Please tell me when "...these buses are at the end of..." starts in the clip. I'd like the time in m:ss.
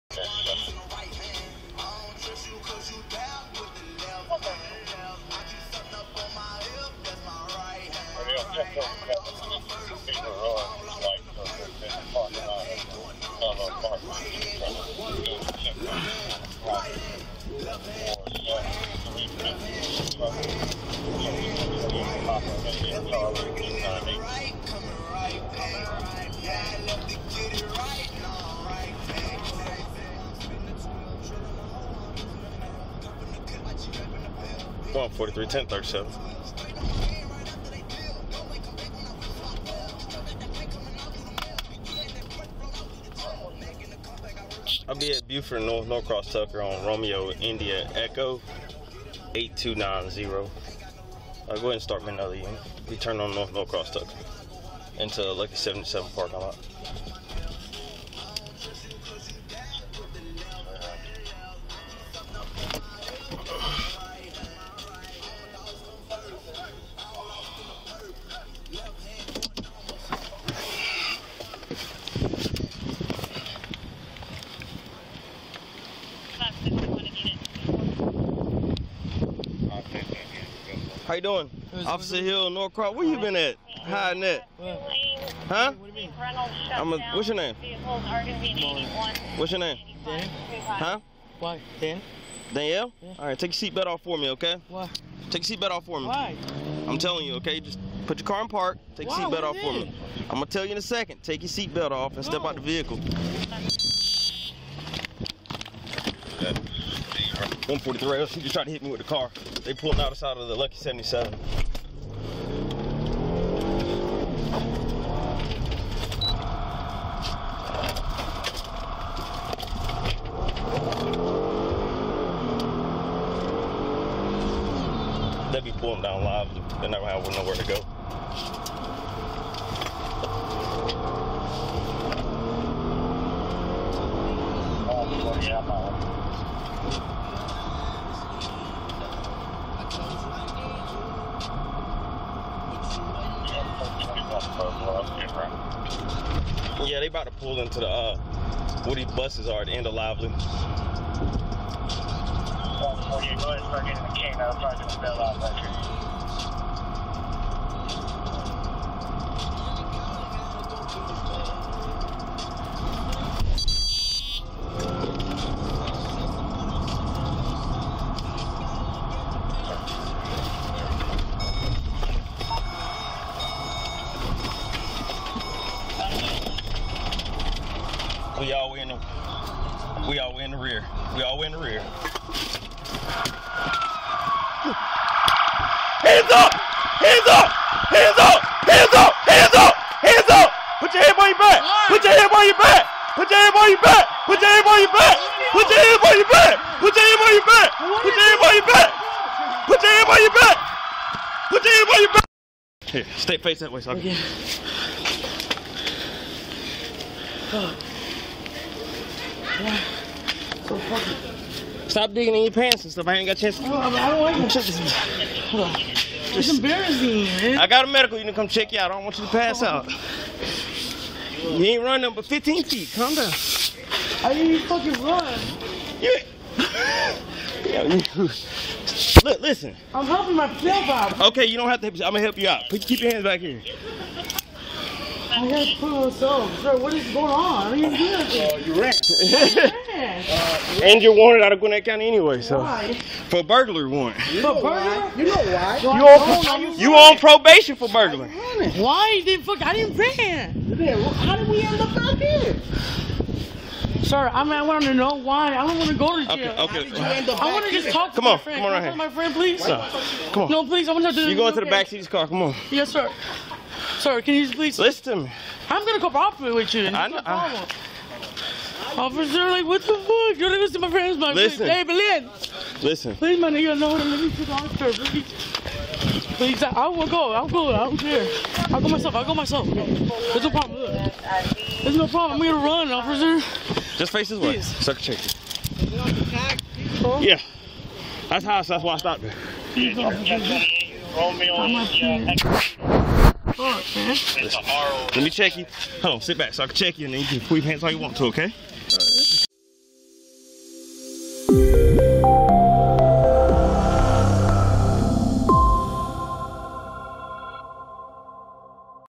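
2:28.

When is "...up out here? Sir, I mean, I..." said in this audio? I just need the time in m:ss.
4:11.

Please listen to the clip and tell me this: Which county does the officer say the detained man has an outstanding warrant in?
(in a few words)
Gwinnett County.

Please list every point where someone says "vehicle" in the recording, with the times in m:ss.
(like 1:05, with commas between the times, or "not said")
1:42.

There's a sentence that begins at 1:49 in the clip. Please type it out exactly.
They pulled out the side of the Lucky 77.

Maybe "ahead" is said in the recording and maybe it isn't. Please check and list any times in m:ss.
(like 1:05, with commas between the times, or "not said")
0:51, 2:33.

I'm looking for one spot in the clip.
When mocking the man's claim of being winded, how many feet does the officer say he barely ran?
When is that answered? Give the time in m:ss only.
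3:42.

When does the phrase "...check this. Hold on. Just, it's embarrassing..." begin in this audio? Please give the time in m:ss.
3:34.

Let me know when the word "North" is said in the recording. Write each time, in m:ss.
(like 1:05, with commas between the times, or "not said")
0:45, 0:53.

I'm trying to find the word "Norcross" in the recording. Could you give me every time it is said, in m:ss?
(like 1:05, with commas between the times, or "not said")
0:45, 0:53, 1:22.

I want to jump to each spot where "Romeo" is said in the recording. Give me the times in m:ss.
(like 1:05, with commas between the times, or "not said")
0:46, 4:51.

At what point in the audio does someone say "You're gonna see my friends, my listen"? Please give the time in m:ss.
4:30.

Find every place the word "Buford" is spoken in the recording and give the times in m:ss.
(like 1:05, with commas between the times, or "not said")
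0:45.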